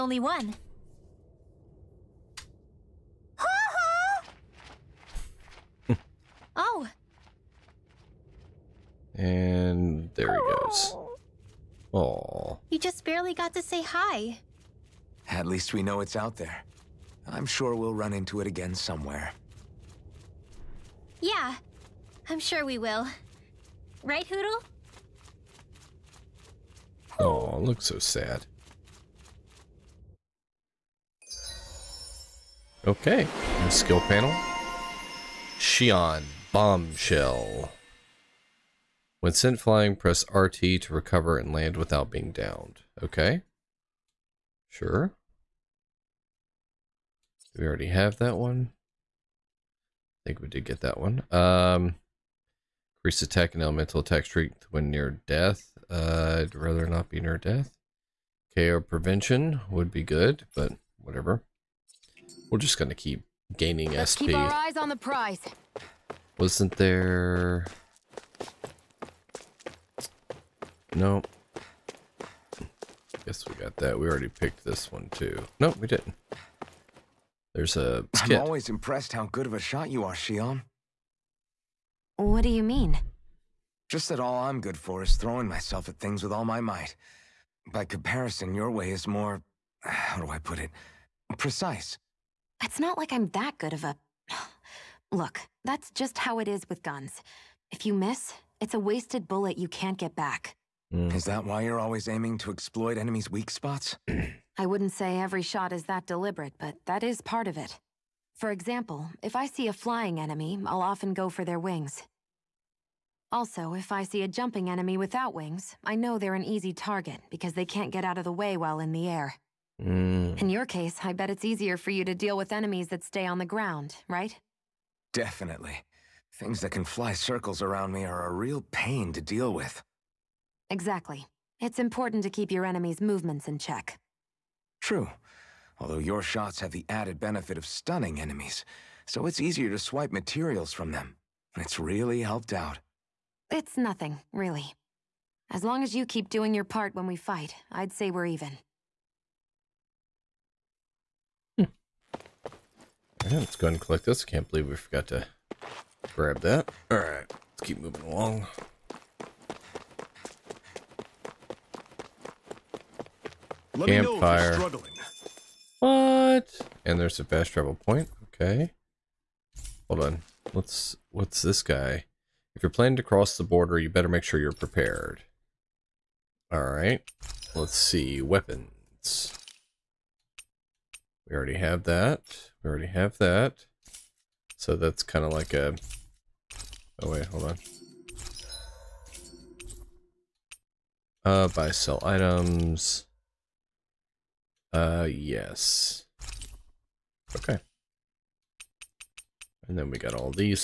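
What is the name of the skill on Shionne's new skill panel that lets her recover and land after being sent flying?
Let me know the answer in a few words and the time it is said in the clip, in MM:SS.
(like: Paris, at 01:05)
Bombshell, at 00:36.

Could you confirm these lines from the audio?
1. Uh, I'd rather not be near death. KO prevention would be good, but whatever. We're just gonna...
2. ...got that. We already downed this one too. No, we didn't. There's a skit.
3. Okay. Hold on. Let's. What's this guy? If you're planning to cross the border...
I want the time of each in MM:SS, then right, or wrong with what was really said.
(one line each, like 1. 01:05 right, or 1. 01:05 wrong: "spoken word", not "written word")
1. 00:55 right
2. 01:13 wrong: "picked", not "downed"
3. 02:48 right.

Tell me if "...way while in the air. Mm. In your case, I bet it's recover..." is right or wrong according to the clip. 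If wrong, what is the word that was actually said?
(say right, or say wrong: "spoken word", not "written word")
wrong: "easier", not "recover".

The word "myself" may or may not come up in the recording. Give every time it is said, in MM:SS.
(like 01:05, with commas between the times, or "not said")
01:25.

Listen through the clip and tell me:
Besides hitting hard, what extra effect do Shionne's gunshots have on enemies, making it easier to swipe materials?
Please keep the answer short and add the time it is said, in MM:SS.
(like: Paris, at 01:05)
Stunning enemies, at 02:17.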